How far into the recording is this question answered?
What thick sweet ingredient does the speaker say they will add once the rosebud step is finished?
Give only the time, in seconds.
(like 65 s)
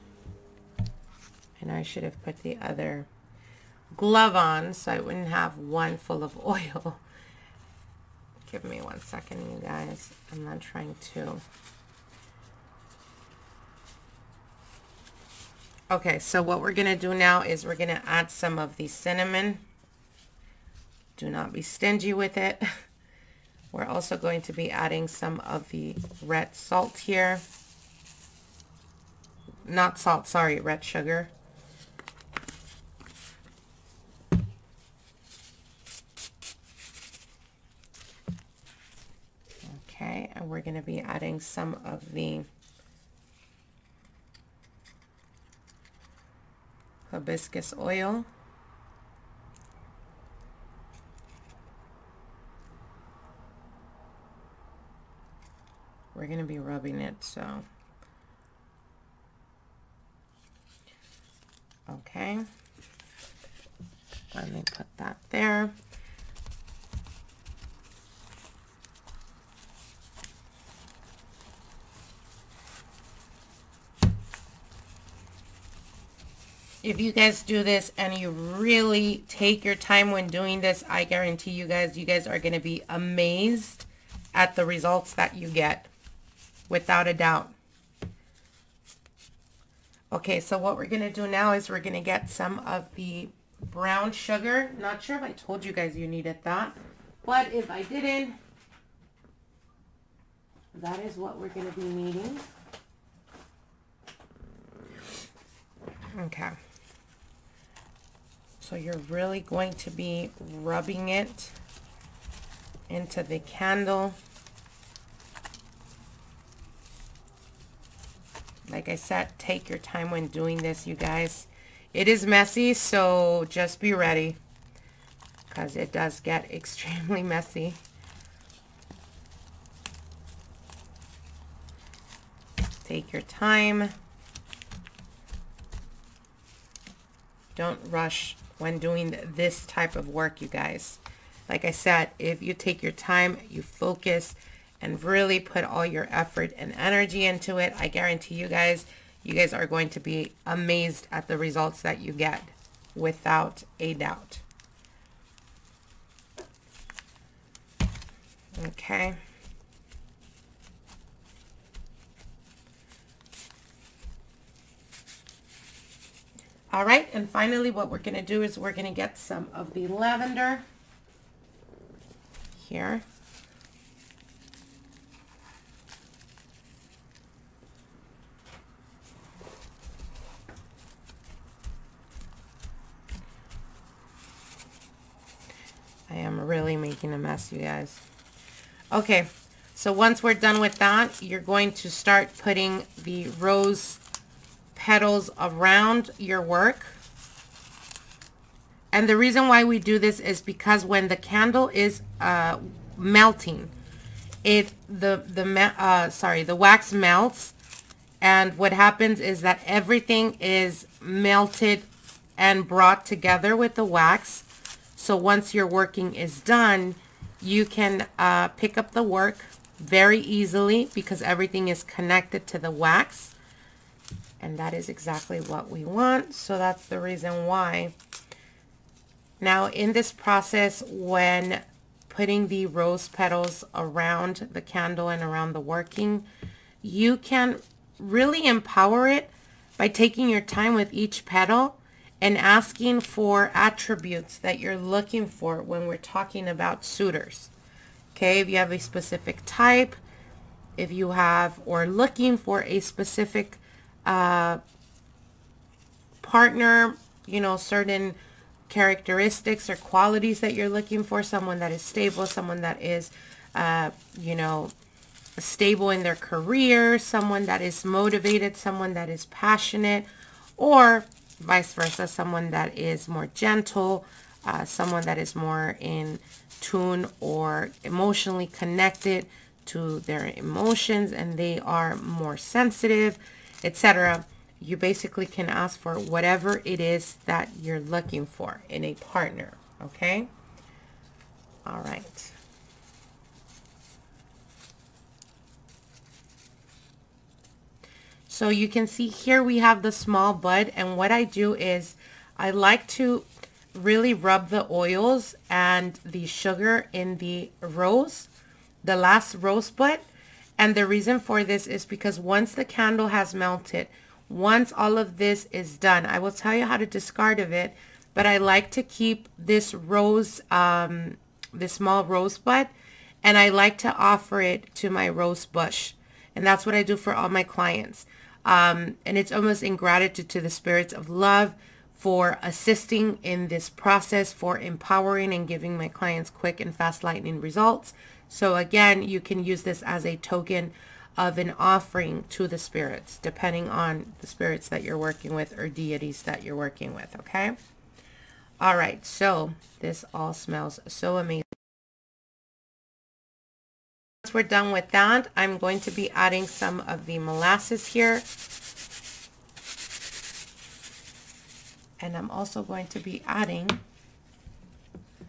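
357 s.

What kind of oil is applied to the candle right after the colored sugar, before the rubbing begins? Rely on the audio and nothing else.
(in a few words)
hibiscus oil.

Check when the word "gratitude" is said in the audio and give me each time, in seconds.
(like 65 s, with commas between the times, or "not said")
329 s.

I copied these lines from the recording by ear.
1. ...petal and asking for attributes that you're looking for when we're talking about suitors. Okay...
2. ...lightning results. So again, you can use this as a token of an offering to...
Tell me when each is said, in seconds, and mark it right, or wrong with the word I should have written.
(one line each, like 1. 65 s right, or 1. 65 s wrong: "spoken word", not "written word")
1. 241 s right
2. 337 s right.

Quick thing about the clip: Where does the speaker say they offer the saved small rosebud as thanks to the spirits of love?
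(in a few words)
to my rose bush.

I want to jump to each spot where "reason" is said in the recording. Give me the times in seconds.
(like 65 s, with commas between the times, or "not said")
199 s, 226 s, 310 s.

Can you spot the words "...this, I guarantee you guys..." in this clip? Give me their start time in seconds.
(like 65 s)
80 s.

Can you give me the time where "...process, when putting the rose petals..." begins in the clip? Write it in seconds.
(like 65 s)
230 s.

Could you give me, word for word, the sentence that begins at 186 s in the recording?
I am really making a mess, you guys.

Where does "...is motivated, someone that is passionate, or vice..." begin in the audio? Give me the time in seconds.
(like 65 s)
267 s.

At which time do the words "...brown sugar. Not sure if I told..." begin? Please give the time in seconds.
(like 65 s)
93 s.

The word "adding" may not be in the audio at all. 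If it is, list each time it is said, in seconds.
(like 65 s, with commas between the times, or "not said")
24 s, 40 s, 356 s, 363 s.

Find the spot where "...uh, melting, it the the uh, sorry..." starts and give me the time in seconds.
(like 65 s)
202 s.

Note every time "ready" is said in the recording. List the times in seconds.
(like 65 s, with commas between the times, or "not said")
123 s.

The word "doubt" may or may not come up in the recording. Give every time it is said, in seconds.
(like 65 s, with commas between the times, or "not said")
87 s, 153 s.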